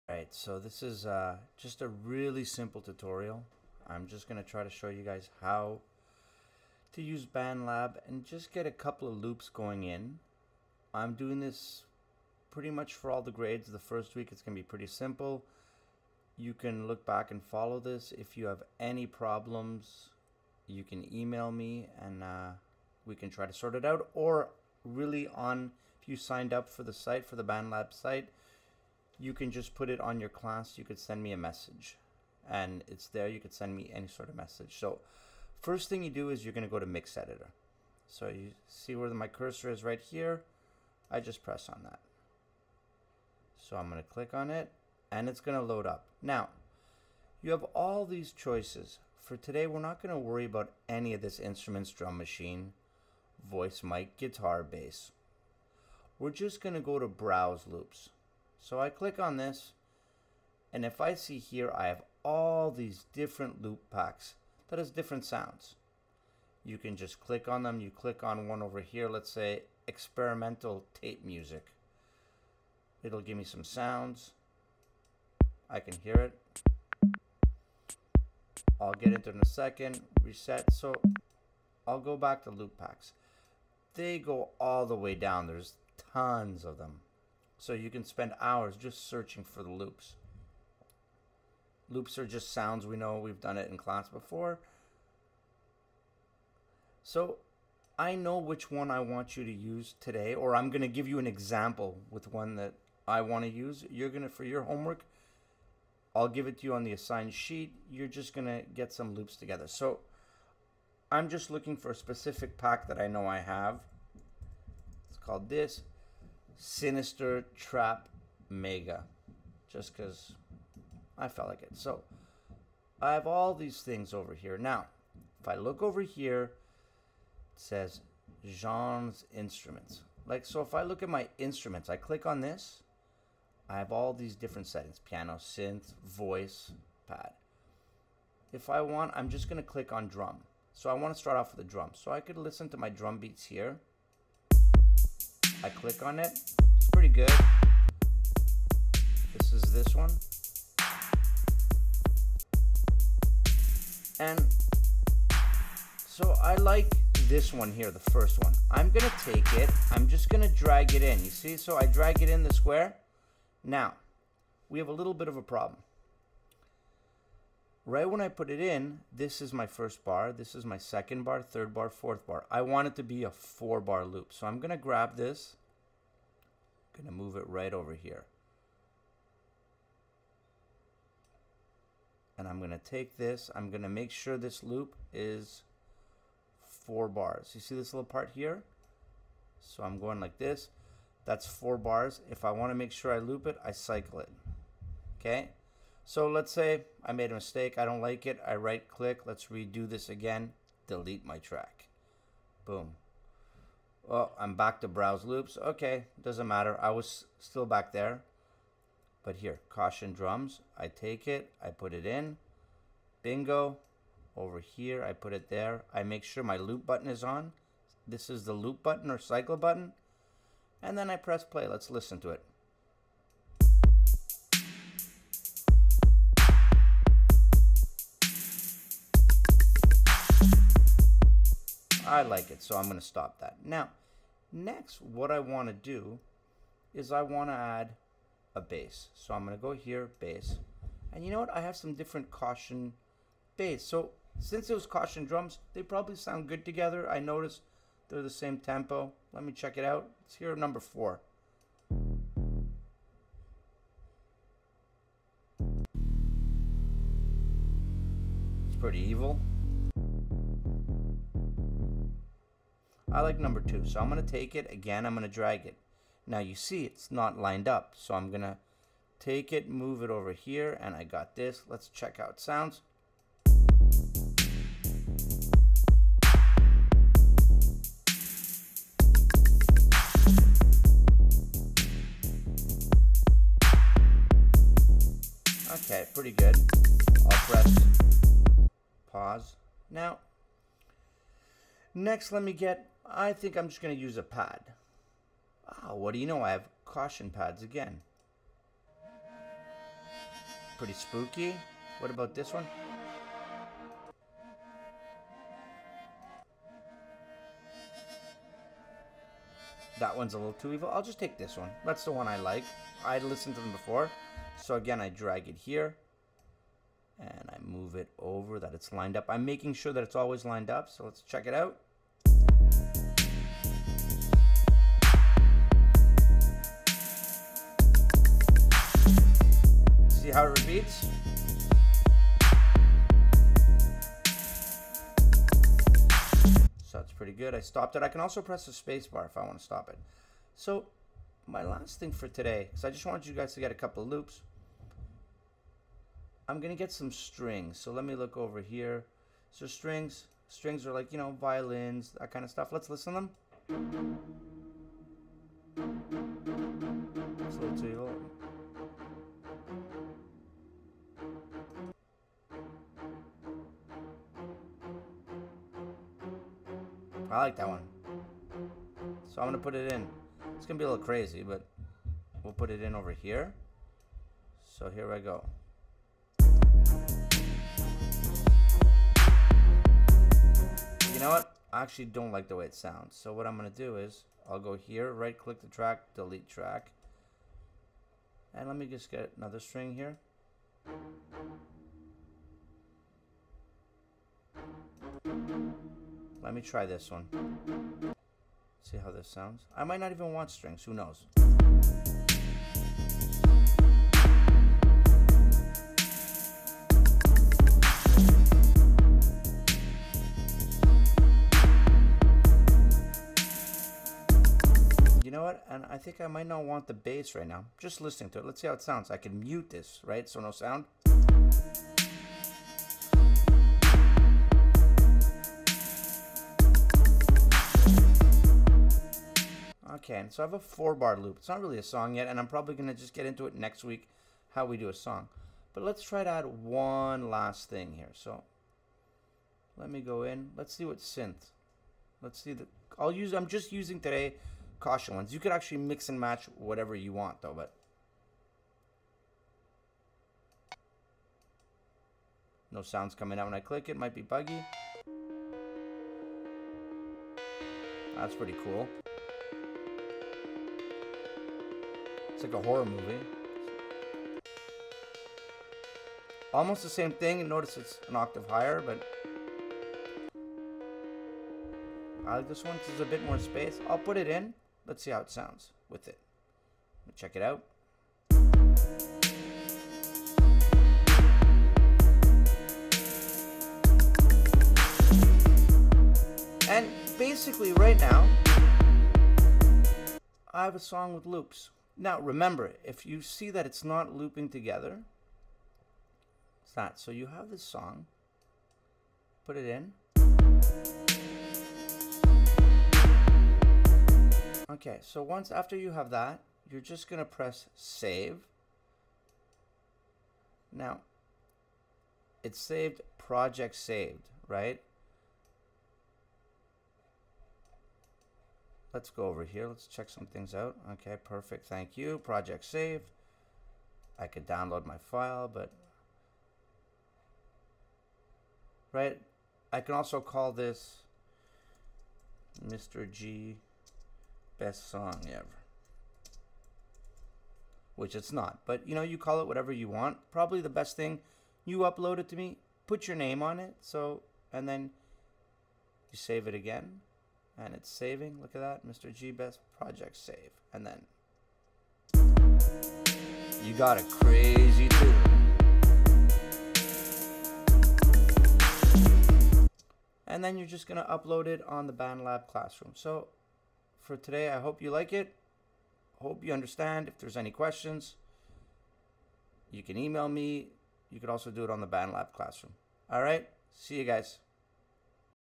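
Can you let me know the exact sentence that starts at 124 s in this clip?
Now, if I look over here, it says Jean's Instruments.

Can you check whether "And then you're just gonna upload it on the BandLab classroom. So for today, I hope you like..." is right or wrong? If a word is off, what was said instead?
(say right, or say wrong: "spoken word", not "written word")
right.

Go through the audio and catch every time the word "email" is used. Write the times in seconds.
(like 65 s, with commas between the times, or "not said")
21 s, 569 s.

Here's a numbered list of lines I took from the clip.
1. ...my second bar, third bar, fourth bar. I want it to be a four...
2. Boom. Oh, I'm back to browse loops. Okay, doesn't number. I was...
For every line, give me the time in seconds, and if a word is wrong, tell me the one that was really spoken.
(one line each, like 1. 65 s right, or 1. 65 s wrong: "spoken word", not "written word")
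1. 170 s right
2. 202 s wrong: "matter", not "number".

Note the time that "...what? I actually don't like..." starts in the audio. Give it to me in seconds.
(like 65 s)
381 s.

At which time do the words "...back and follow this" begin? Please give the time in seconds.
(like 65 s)
17 s.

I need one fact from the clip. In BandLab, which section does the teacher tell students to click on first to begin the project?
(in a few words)
Mix Editor.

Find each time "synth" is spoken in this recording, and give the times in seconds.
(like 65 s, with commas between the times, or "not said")
135 s, 440 s.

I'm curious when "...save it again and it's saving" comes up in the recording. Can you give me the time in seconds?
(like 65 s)
546 s.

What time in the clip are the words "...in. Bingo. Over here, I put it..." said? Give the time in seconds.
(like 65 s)
212 s.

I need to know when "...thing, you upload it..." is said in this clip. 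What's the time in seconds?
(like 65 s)
540 s.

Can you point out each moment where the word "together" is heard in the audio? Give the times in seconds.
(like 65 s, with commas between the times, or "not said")
109 s, 246 s, 494 s.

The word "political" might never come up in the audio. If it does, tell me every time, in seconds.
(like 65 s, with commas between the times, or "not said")
not said.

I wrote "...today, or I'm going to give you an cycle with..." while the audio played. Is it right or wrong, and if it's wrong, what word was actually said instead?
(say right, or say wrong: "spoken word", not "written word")
wrong: "example", not "cycle".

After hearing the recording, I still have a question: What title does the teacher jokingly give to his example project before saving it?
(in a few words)
Mr. G best song ever.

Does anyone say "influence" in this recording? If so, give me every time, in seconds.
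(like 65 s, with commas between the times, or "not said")
not said.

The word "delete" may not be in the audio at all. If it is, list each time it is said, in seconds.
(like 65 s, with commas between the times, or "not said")
200 s, 386 s.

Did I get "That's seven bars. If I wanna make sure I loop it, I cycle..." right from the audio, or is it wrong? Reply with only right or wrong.
wrong.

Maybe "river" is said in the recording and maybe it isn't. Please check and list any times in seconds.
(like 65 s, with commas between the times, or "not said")
not said.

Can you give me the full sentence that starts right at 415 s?
And I think I might not want the bass right now.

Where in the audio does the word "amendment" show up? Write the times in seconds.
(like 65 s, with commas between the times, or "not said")
not said.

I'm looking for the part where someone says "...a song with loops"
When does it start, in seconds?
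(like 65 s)
490 s.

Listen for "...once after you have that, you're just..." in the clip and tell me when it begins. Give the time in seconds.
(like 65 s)
505 s.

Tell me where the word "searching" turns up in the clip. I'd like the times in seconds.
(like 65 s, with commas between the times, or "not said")
89 s.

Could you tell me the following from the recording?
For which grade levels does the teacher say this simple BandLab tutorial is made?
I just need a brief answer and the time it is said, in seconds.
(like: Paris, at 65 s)
All the grades, at 13 s.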